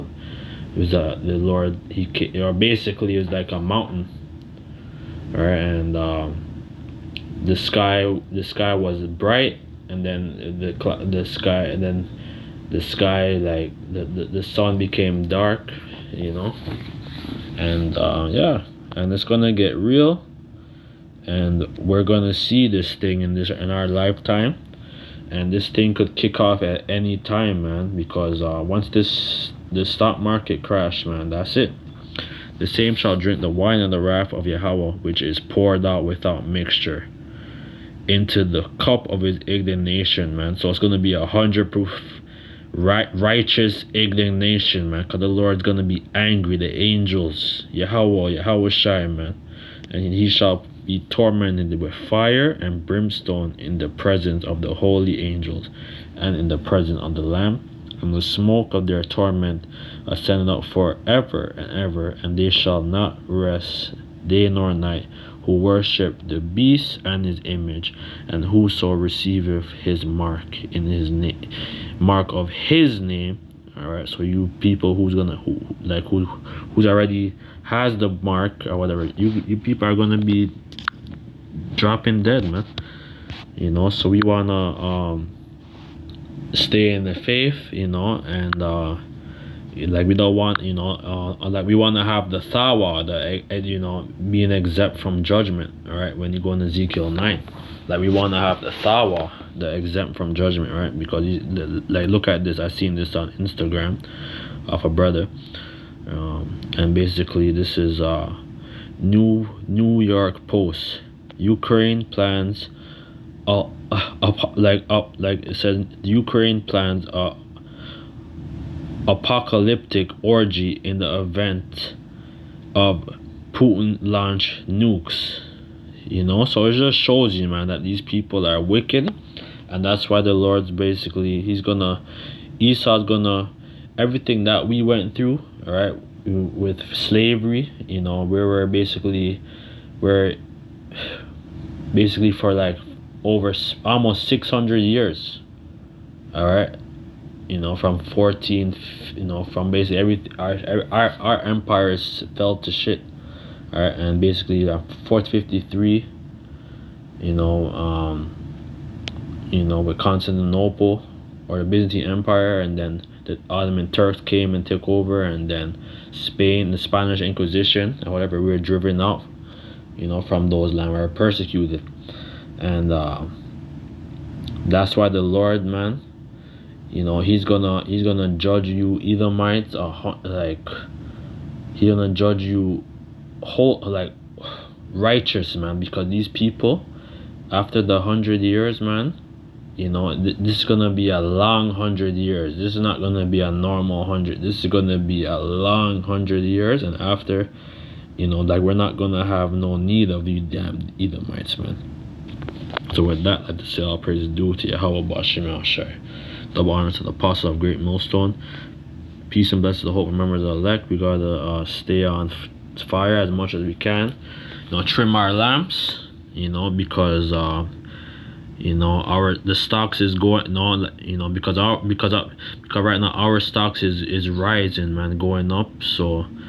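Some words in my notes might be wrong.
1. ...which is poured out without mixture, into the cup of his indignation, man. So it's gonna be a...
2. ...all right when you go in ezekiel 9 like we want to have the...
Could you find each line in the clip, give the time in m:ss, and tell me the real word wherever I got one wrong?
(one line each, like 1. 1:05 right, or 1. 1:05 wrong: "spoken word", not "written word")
1. 0:35 right
2. 1:35 right.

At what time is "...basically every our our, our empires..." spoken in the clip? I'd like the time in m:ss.
2:29.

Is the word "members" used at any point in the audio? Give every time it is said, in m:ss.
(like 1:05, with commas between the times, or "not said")
3:30.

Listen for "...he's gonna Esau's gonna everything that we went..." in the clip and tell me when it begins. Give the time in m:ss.
2:11.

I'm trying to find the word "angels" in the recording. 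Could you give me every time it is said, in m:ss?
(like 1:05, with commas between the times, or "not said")
0:46, 0:55.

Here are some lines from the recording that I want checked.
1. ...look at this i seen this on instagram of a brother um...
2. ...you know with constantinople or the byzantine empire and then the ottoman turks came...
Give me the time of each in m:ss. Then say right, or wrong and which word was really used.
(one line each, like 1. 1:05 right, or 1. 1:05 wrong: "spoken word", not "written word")
1. 1:42 right
2. 2:39 right.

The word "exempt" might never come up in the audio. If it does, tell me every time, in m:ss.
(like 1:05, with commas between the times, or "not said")
1:34, 1:39.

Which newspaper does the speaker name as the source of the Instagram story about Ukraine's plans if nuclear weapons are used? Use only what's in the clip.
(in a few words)
New York Post.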